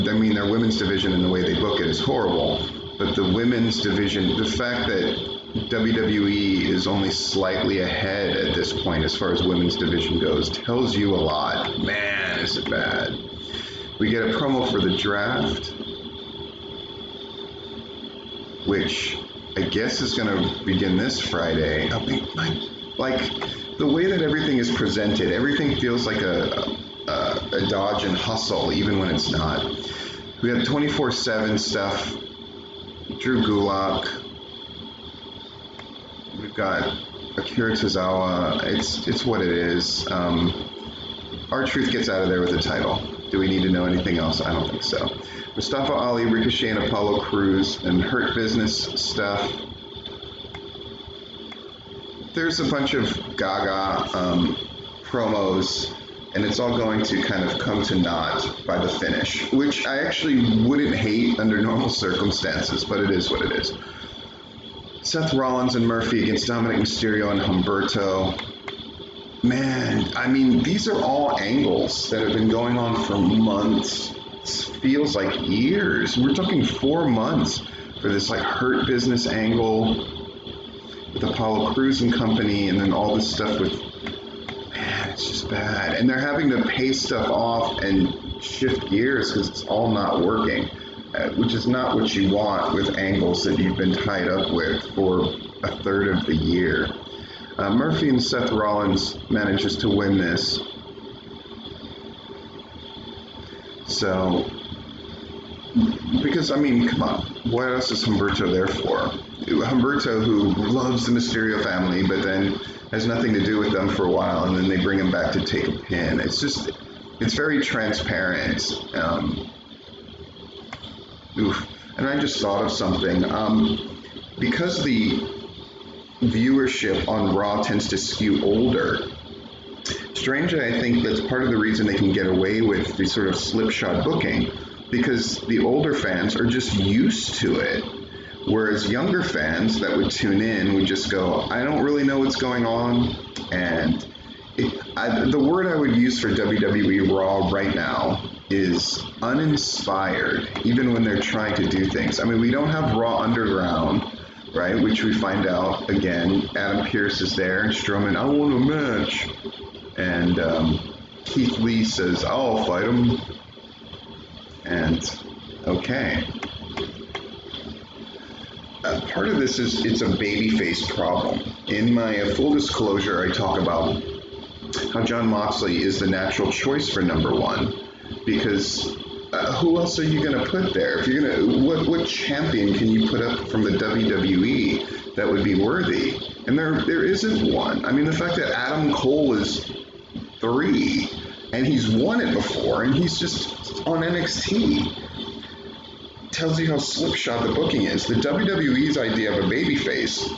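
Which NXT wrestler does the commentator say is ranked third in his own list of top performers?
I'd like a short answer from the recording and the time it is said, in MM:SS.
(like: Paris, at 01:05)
Adam Cole, at 03:08.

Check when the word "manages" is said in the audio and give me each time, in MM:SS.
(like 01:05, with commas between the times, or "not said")
01:39.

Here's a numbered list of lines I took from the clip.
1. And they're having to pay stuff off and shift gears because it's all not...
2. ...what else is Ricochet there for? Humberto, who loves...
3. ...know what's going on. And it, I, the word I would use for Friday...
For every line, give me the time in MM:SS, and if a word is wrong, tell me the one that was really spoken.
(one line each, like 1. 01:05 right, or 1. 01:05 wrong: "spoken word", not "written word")
1. 01:25 right
2. 01:47 wrong: "Humberto", not "Ricochet"
3. 02:22 wrong: "WWE", not "Friday".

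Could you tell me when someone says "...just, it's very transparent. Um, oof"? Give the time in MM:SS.
01:56.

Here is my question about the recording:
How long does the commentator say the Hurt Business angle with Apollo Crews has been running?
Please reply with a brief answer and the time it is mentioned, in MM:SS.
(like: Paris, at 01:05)
4 months, at 01:16.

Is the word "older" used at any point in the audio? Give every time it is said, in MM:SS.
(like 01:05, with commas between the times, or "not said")
02:08, 02:15.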